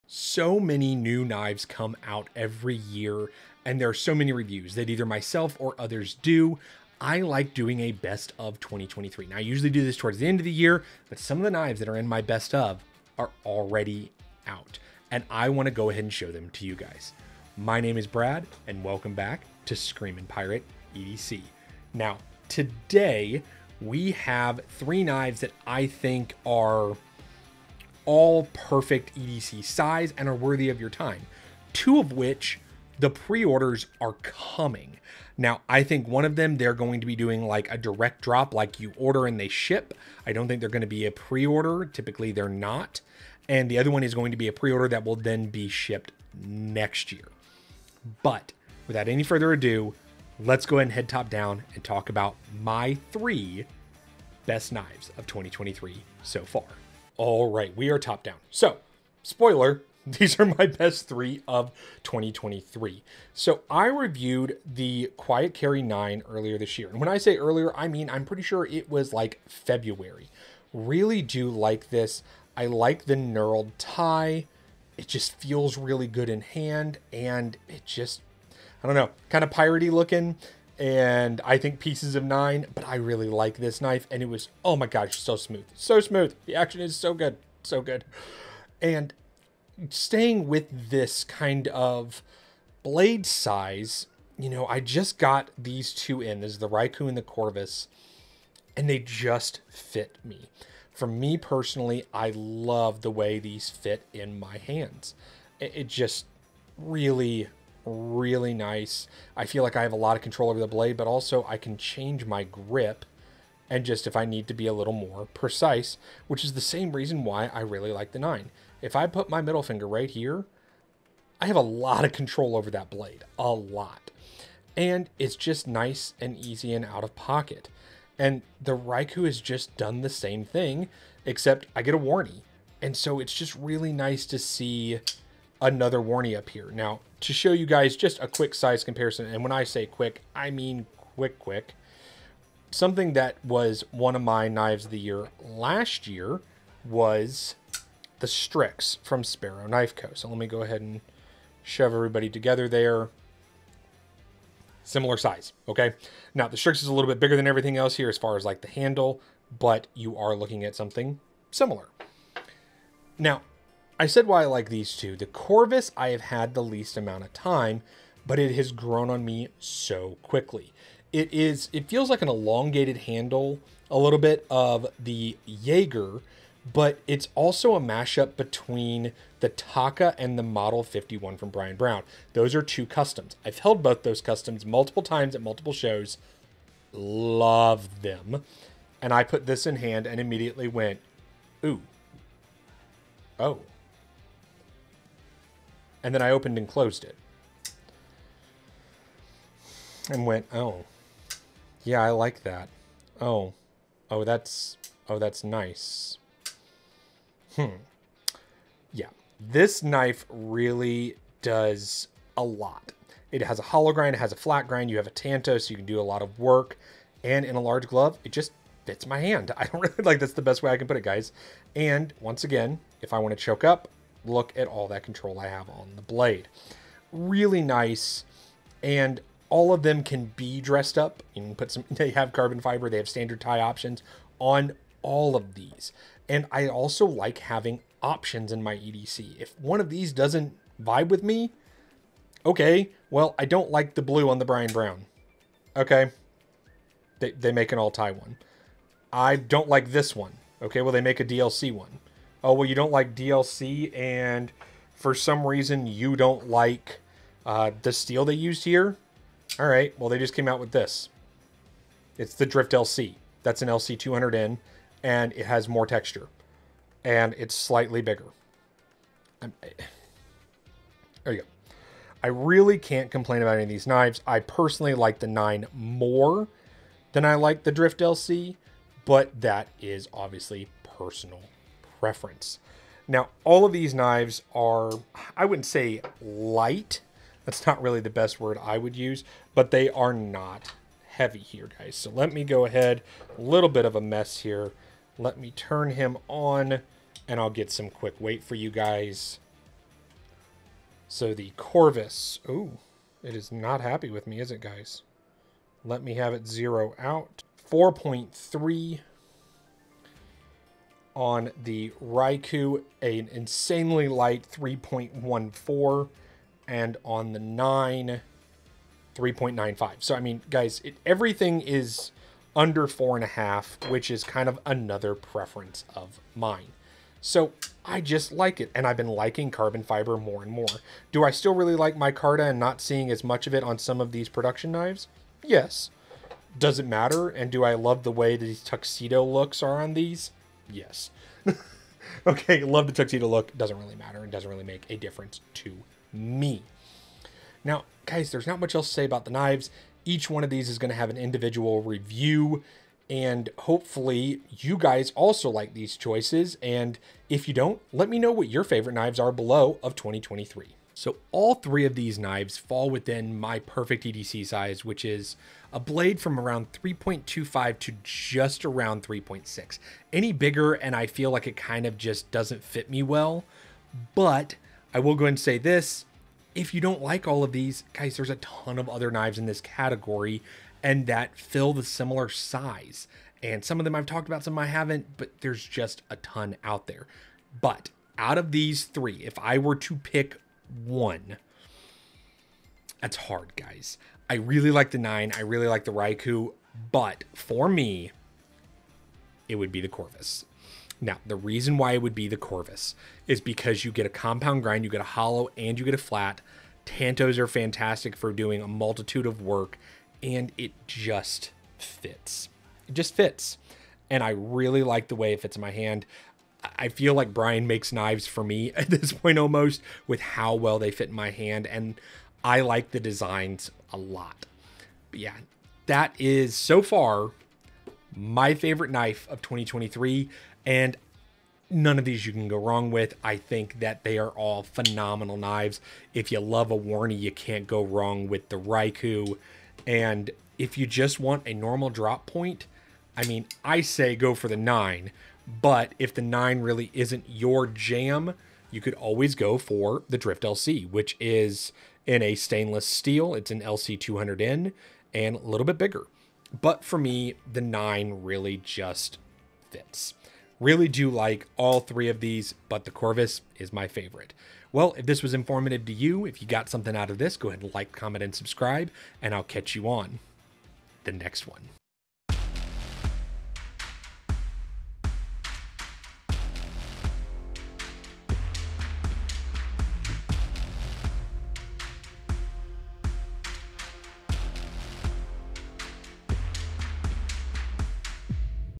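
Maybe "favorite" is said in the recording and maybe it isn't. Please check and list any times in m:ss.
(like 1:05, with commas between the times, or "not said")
5:58, 7:08, 7:43.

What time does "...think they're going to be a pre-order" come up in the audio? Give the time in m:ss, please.
0:40.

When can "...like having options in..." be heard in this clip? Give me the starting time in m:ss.
3:57.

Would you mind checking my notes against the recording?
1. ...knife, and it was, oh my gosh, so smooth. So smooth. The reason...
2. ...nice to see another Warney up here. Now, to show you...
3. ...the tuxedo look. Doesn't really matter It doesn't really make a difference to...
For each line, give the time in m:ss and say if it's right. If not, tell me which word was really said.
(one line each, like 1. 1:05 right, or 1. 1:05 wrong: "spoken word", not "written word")
1. 1:23 wrong: "action", not "reason"
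2. 2:13 right
3. 5:42 right.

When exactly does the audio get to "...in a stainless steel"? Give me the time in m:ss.
7:32.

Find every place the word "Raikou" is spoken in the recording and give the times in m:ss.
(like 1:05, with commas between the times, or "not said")
1:36, 2:08, 5:12, 6:35, 7:18.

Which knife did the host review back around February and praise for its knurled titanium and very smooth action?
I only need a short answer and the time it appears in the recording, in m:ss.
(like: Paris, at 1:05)
Quiet Carry 9, at 1:05.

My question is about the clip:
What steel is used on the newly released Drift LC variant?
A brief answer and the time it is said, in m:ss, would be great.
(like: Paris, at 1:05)
LC 200N, at 4:23.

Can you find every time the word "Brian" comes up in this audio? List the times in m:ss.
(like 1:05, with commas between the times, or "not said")
3:01, 4:04, 6:57.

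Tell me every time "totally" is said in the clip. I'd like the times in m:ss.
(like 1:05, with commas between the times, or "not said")
not said.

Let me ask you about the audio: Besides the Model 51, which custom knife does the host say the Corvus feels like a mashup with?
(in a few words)
Taka.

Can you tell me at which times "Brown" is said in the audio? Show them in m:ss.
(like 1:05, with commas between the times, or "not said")
3:01, 4:04.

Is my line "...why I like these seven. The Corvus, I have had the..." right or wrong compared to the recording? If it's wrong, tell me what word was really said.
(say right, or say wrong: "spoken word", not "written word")
wrong: "two", not "seven".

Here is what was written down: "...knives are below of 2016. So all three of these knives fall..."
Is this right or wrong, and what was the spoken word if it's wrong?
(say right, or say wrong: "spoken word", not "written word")
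wrong: "2023", not "2016".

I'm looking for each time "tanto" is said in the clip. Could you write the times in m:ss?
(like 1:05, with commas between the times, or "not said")
3:35, 6:46.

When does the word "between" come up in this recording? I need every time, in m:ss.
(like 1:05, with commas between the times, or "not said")
2:58.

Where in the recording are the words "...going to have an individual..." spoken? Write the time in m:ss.
5:50.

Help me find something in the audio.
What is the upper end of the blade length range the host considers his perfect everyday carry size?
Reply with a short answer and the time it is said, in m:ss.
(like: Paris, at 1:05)
3.6, at 6:09.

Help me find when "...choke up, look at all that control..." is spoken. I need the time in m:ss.
3:43.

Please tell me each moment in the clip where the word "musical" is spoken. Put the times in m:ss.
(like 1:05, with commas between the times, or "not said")
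not said.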